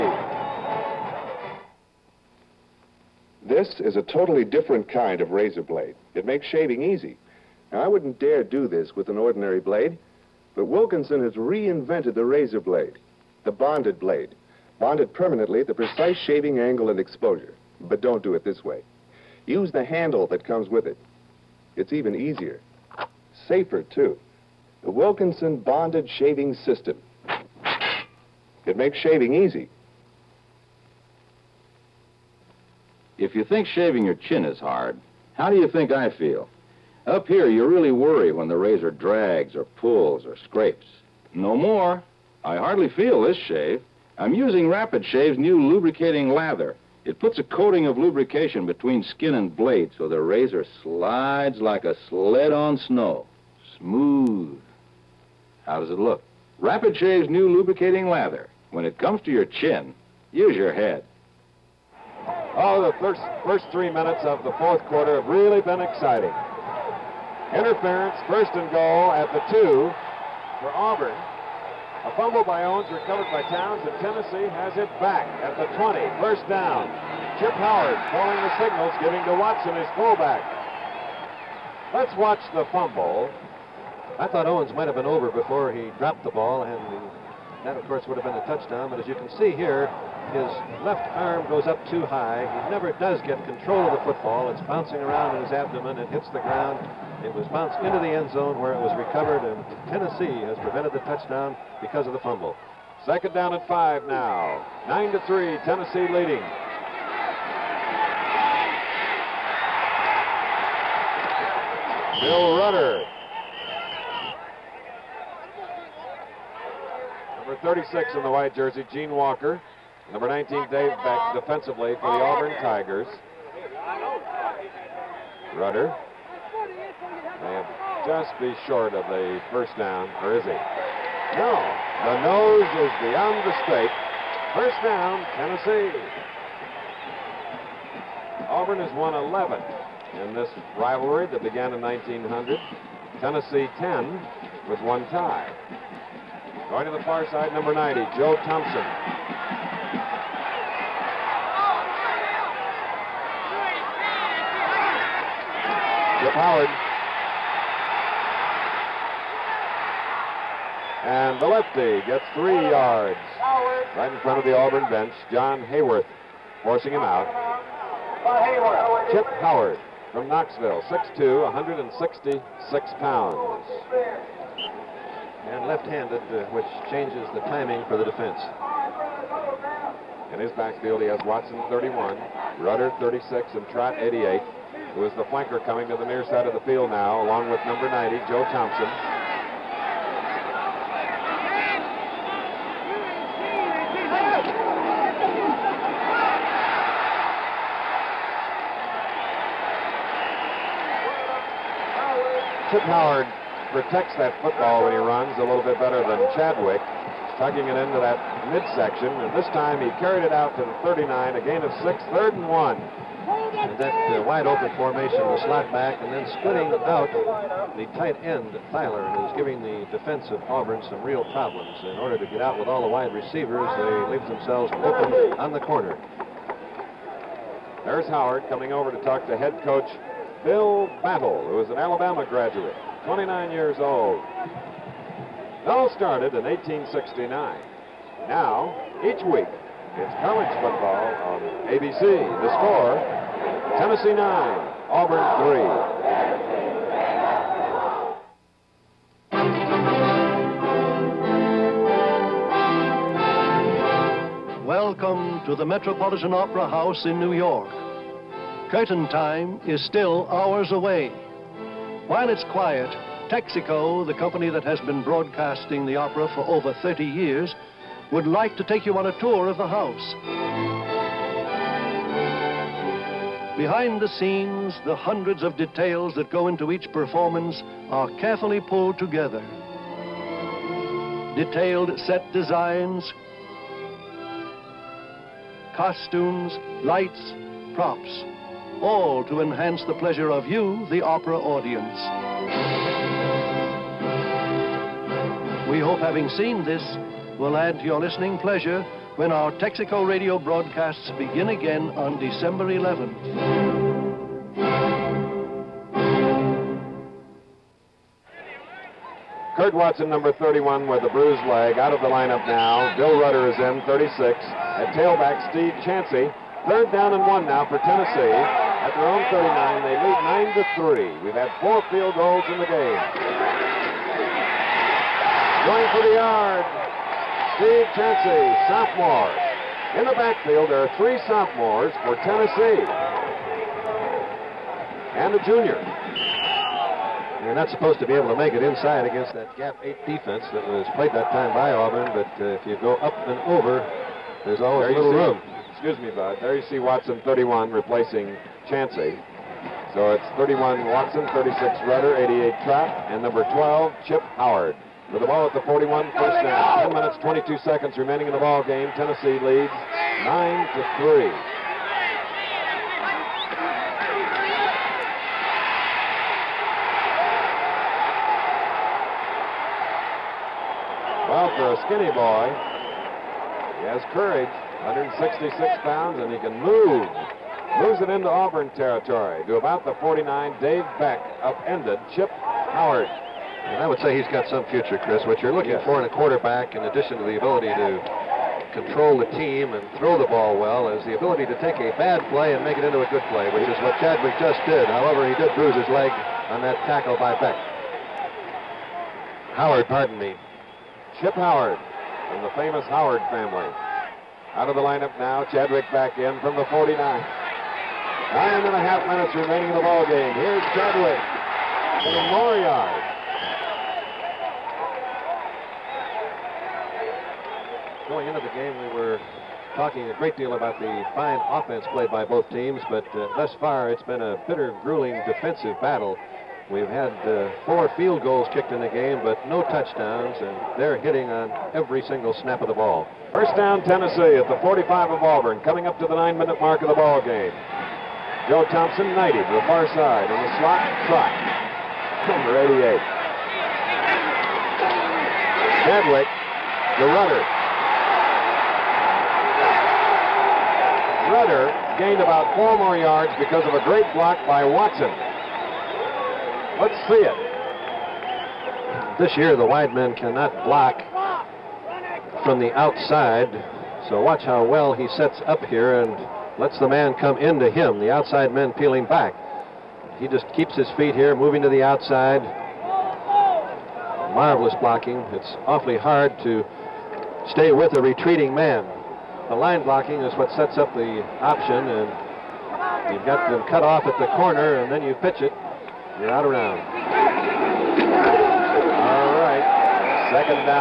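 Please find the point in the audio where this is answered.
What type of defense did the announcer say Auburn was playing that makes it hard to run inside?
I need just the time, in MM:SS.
05:39.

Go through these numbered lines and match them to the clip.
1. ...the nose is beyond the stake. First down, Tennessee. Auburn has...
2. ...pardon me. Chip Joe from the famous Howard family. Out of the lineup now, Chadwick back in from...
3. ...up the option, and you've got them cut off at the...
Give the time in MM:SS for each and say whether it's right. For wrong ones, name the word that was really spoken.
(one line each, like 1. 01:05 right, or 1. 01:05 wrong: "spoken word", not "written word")
1. 02:12 right
2. 06:39 wrong: "Howard", not "Joe"
3. 08:00 right.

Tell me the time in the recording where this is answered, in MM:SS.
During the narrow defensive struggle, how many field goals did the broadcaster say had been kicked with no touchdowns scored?
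07:07.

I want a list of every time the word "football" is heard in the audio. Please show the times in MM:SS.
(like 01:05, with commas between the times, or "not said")
01:34, 03:24, 04:00.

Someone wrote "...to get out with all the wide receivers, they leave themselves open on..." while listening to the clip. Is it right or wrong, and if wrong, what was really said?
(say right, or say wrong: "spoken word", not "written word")
right.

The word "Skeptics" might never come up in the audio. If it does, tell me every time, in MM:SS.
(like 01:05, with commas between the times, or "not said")
not said.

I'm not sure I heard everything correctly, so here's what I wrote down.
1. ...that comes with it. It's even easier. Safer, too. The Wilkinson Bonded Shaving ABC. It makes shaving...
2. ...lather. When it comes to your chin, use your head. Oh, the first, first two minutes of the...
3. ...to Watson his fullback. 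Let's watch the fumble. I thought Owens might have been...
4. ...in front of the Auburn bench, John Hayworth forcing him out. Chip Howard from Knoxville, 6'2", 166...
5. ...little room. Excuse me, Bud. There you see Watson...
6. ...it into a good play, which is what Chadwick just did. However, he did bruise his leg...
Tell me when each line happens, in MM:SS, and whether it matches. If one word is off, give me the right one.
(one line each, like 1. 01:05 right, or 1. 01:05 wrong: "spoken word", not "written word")
1. 00:20 wrong: "System", not "ABC"
2. 00:58 wrong: "three", not "two"
3. 01:19 right
4. 02:44 right
5. 05:44 right
6. 06:32 right.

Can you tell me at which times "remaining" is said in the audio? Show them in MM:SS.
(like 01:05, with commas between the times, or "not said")
05:57, 06:49.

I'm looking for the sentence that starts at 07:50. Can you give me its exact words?
He just keeps his feet here, moving to the outside.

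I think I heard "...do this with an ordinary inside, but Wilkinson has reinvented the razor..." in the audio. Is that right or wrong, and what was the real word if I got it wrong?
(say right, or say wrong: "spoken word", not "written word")
wrong: "blade", not "inside".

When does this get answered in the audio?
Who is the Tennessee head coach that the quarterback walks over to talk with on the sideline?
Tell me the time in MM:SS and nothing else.
03:49.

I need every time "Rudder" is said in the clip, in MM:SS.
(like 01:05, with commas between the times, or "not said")
01:52, 02:05, 03:02, 05:13, 05:51.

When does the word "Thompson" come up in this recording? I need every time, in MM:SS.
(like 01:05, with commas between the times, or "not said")
02:28, 03:08, 07:18.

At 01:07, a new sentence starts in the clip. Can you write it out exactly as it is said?
Interference, first and goal at the two for Auburn.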